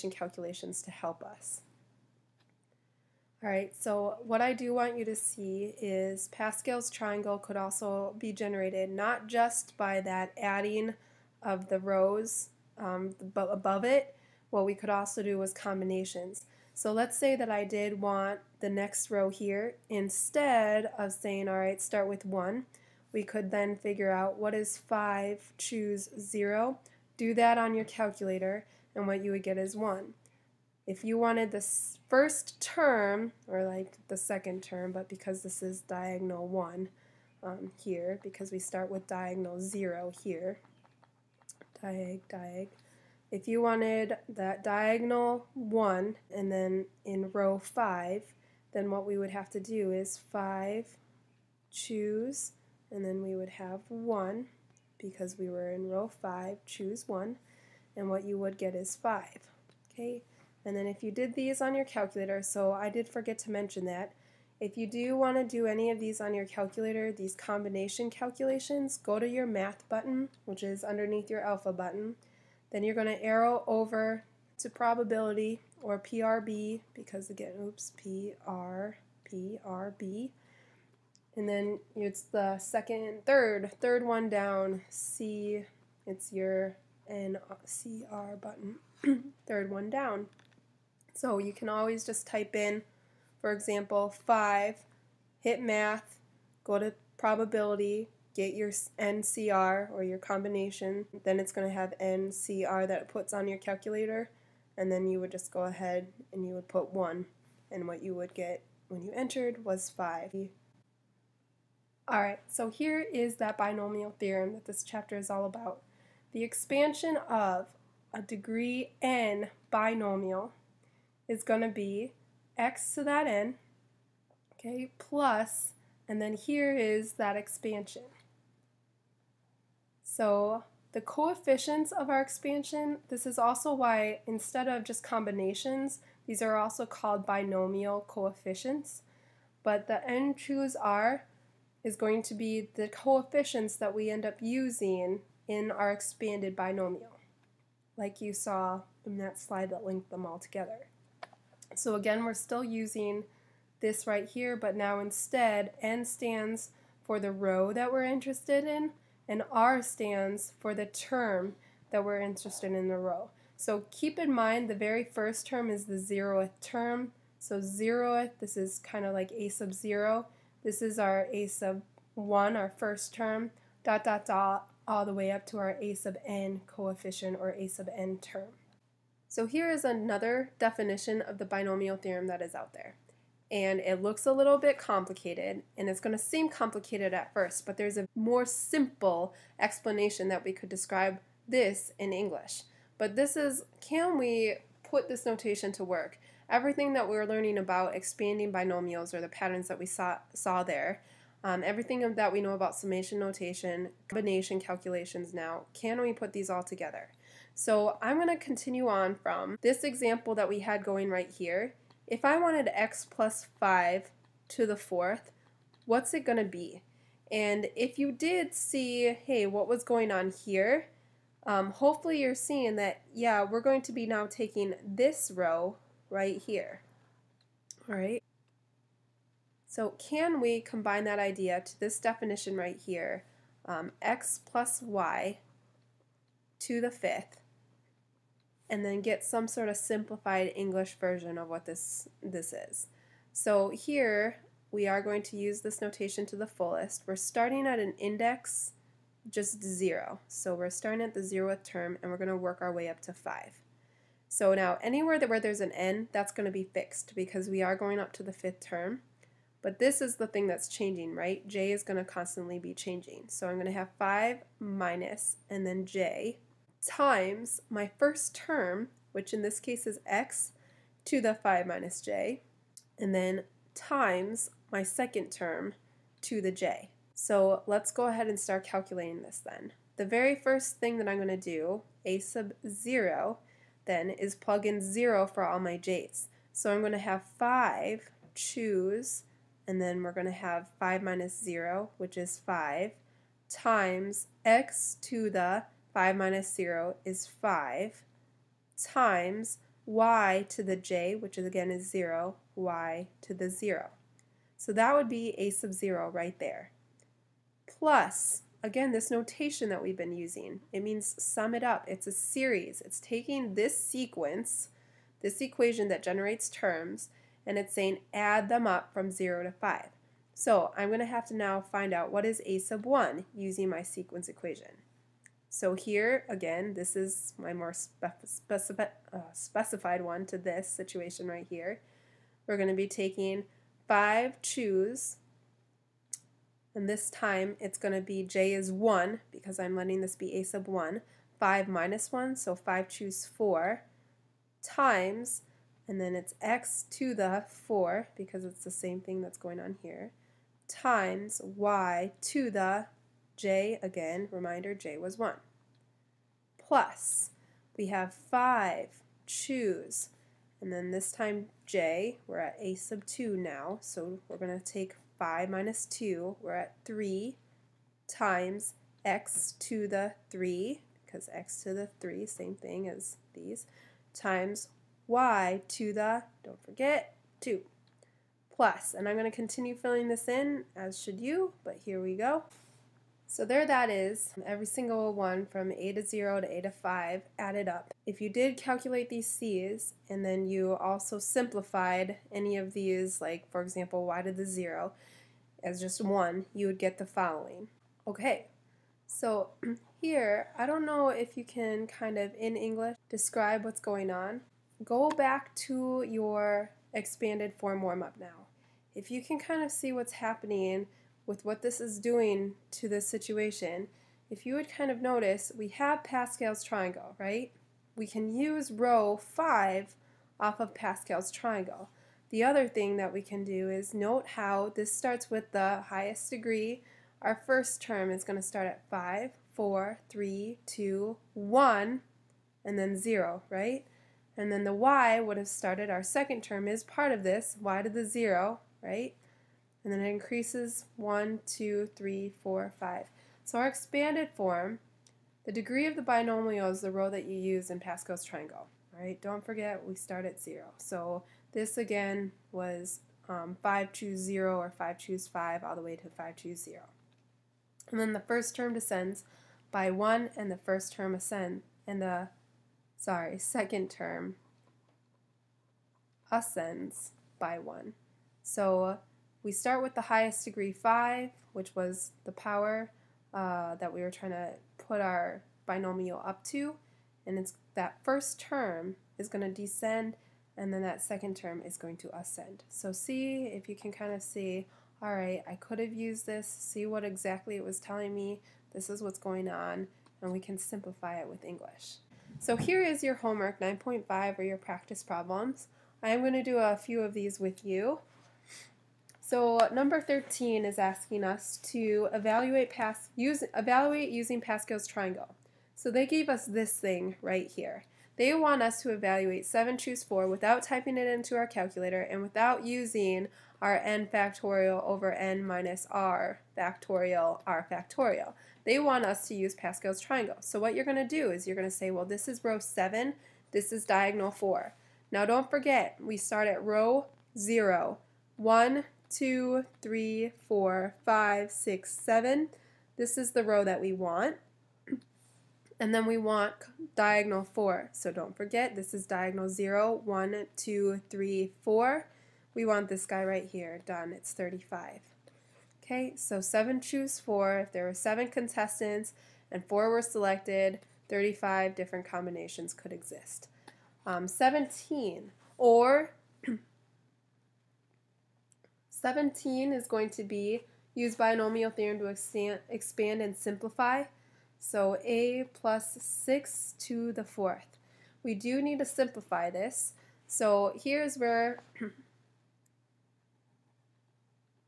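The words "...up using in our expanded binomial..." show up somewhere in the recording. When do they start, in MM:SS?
02:24.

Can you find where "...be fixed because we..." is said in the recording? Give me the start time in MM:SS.
04:16.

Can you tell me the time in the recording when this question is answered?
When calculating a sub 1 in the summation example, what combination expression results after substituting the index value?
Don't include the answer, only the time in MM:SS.
05:42.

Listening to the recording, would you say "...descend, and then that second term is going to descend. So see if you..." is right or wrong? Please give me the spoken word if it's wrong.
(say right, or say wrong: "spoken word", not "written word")
wrong: "ascend", not "descend".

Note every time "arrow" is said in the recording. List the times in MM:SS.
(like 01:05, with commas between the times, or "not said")
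01:13.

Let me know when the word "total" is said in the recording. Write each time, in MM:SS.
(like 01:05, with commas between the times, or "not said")
not said.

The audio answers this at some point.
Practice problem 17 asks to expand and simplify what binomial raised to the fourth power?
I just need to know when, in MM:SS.
09:25.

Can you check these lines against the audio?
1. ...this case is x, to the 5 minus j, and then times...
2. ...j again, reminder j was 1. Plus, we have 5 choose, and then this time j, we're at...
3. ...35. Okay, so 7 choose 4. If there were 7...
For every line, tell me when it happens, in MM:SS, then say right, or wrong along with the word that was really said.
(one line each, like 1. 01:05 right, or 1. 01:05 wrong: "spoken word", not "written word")
1. 04:29 right
2. 05:53 right
3. 09:04 right.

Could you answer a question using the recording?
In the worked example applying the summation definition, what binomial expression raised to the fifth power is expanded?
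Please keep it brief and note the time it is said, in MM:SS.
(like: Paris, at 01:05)
x plus y, at 03:54.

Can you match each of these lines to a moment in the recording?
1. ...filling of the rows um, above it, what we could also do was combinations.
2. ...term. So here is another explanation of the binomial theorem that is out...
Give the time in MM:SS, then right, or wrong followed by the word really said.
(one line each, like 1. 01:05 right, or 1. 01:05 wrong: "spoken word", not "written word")
1. 00:10 wrong: "adding", not "filling"
2. 02:58 wrong: "definition", not "explanation".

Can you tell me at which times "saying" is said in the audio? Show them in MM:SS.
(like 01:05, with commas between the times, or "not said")
00:21, 05:17.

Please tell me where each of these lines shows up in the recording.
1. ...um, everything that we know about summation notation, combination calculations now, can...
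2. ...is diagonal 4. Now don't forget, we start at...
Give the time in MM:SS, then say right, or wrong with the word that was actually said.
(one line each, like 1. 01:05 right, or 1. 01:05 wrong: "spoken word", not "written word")
1. 03:21 right
2. 08:43 right.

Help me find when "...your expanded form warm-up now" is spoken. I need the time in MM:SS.
06:46.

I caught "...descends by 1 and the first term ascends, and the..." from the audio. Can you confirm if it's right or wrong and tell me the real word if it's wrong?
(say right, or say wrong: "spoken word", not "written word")
right.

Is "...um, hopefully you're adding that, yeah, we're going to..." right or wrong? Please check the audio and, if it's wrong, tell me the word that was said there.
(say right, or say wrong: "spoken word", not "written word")
wrong: "seeing", not "adding".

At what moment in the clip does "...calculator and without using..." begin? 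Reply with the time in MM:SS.
08:31.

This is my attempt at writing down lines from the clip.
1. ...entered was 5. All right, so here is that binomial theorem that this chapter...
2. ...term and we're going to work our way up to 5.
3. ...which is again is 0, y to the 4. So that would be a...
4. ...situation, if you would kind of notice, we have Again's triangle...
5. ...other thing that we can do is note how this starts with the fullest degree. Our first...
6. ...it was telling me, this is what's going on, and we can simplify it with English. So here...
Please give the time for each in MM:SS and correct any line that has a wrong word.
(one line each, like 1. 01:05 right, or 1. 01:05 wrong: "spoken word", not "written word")
1. 01:49 right
2. 04:11 right
3. 05:01 wrong: "0", not "4"
4. 06:53 wrong: "Pascal", not "Again"
5. 07:02 wrong: "highest", not "fullest"
6. 08:07 right.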